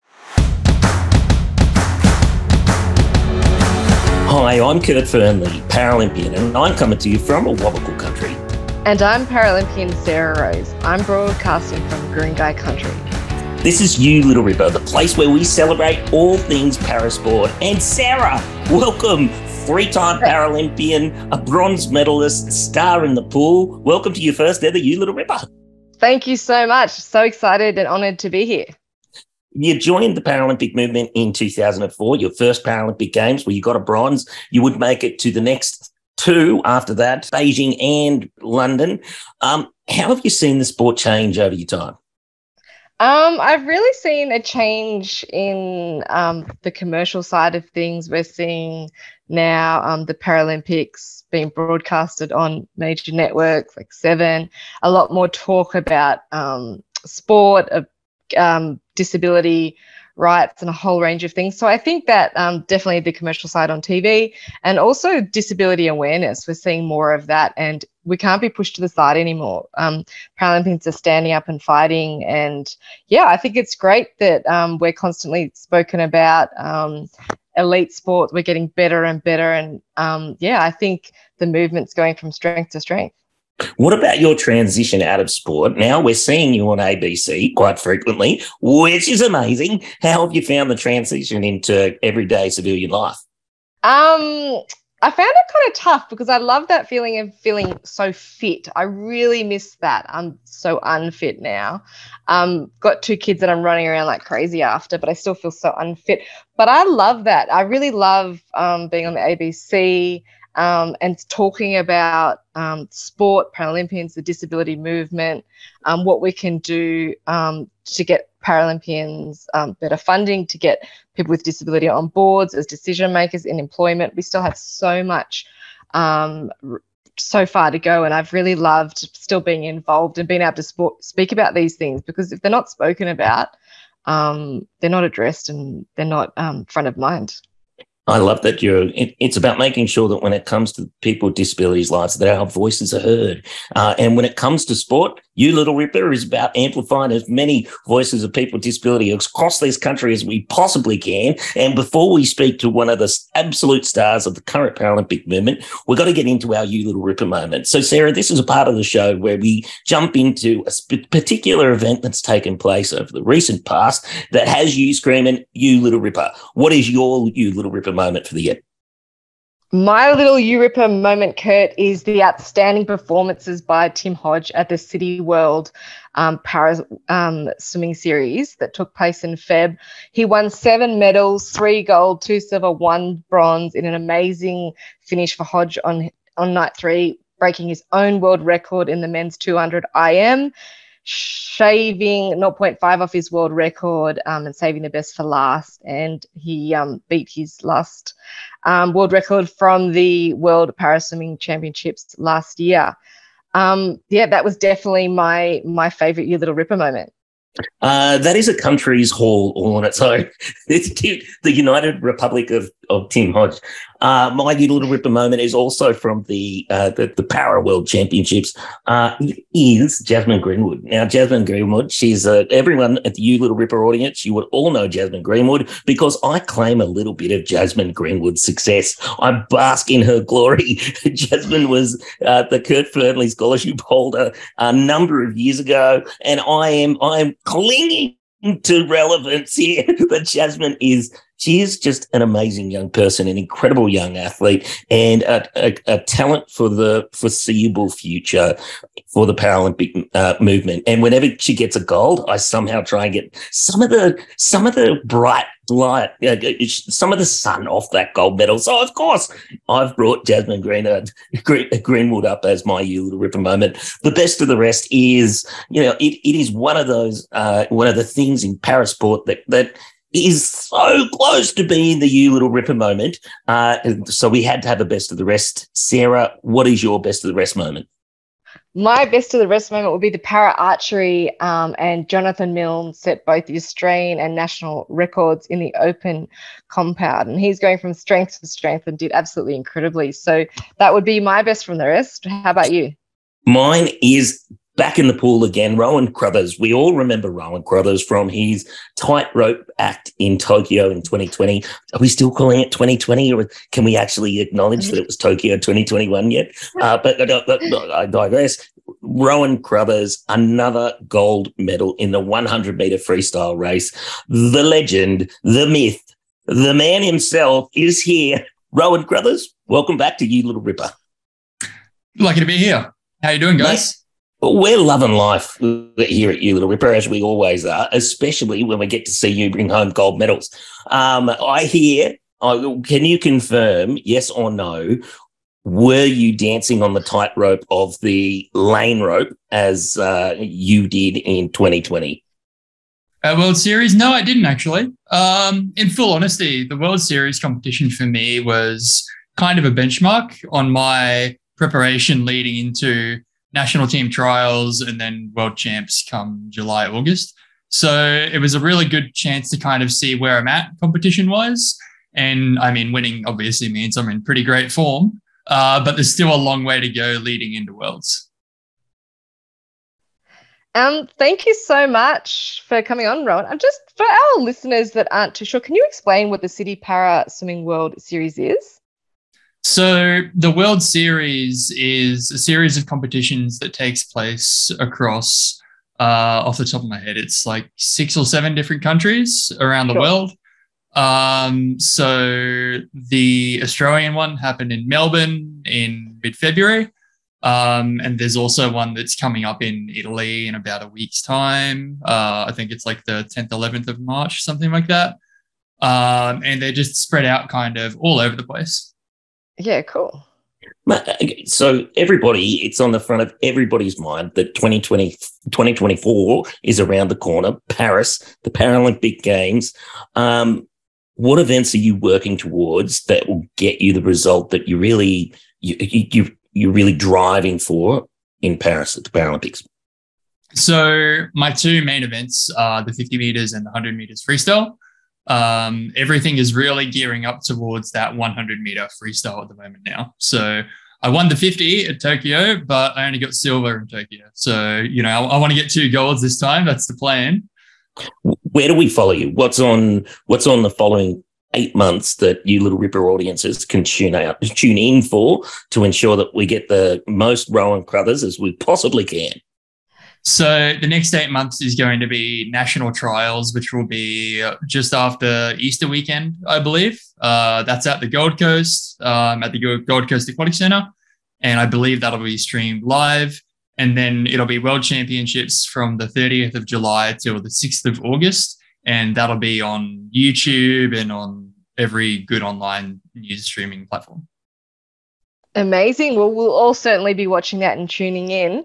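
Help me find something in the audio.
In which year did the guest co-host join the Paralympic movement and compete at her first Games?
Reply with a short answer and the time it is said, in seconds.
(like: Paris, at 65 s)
2004, at 31 s.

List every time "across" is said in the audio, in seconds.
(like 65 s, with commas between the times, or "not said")
149 s, 384 s.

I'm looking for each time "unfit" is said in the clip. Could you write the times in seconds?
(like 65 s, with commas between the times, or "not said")
100 s, 105 s.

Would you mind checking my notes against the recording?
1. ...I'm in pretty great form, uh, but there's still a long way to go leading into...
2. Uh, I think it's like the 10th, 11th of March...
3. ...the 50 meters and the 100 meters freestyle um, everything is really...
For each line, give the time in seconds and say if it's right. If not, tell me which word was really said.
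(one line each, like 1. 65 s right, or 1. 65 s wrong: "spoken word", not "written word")
1. 363 s right
2. 402 s right
3. 432 s right.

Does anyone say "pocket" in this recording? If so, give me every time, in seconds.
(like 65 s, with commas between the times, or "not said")
not said.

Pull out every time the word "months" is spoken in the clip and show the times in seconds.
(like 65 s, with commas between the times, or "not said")
451 s, 461 s.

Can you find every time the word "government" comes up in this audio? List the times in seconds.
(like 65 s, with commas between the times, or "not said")
not said.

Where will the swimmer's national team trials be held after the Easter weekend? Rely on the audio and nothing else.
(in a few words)
Gold Coast Aquatic Center.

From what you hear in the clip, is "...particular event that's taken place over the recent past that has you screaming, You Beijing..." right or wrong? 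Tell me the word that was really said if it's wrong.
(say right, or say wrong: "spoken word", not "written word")
wrong: "Little", not "Beijing".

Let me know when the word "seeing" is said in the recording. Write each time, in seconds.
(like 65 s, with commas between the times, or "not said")
48 s, 66 s, 86 s.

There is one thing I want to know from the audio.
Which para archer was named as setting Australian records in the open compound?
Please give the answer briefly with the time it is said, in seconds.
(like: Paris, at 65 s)
Jonathan Milne, at 282 s.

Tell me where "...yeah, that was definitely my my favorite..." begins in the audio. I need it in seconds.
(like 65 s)
204 s.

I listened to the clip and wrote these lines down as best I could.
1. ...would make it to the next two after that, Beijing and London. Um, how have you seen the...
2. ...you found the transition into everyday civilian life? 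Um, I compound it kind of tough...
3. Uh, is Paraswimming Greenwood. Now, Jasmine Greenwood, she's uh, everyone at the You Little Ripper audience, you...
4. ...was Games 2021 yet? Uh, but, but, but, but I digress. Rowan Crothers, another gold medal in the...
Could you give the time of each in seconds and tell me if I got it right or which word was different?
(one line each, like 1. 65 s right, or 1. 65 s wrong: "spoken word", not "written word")
1. 34 s right
2. 90 s wrong: "found", not "compound"
3. 218 s wrong: "Jasmine", not "Paraswimming"
4. 305 s wrong: "Tokyo", not "Games".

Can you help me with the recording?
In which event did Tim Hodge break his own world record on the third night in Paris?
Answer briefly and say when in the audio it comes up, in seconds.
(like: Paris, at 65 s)
men's 200 IM, at 189 s.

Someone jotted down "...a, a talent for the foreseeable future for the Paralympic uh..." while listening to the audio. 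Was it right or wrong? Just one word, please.
right.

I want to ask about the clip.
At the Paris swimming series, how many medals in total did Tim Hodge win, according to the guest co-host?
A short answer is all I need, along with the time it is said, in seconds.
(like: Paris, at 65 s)
7, at 180 s.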